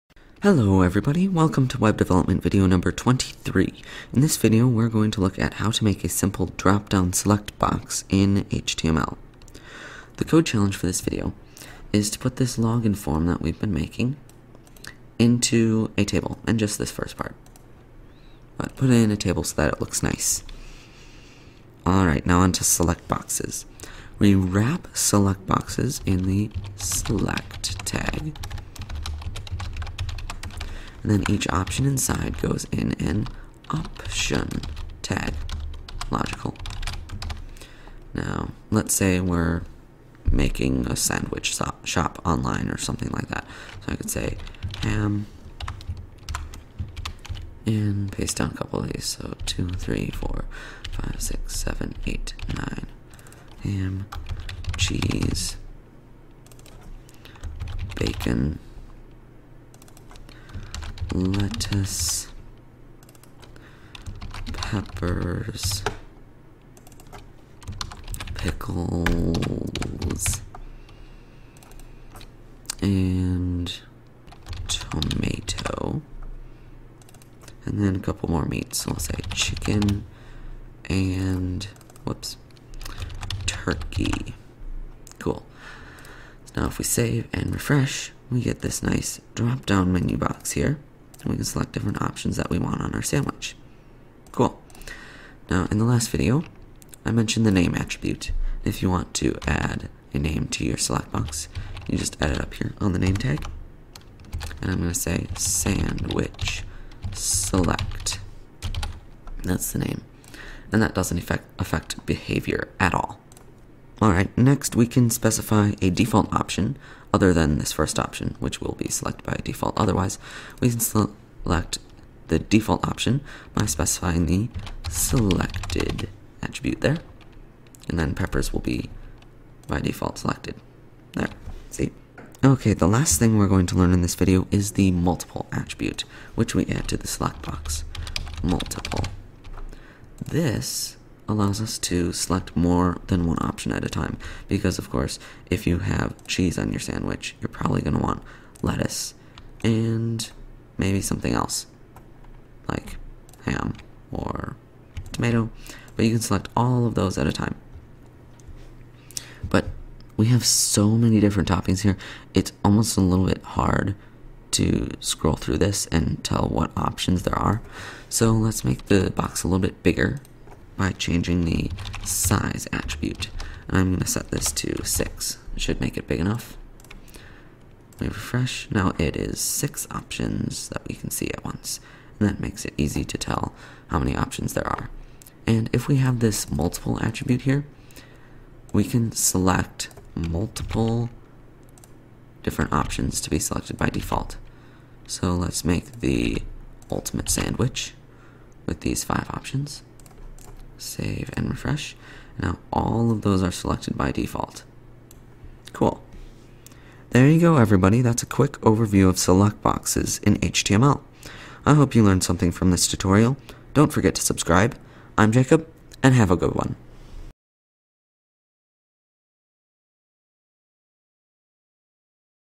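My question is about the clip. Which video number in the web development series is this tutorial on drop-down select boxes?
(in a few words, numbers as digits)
23.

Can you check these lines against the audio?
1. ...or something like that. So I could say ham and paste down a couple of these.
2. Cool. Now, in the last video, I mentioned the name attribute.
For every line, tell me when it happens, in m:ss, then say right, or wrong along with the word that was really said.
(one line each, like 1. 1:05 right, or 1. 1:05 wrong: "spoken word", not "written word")
1. 0:42 right
2. 1:34 right.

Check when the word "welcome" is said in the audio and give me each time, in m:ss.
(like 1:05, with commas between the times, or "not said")
0:01.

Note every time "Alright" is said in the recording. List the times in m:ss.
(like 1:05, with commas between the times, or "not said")
0:21, 1:54.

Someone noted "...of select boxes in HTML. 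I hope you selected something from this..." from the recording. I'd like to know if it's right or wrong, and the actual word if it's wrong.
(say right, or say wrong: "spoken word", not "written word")
wrong: "learned", not "selected".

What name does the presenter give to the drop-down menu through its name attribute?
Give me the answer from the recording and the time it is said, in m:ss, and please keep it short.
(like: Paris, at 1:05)
sandwich select, at 1:45.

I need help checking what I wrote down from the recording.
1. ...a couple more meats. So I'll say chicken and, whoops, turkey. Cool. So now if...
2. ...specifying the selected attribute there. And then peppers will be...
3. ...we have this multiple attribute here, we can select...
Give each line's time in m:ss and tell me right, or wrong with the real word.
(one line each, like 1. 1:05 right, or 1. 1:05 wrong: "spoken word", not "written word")
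1. 1:17 right
2. 2:03 right
3. 3:05 right.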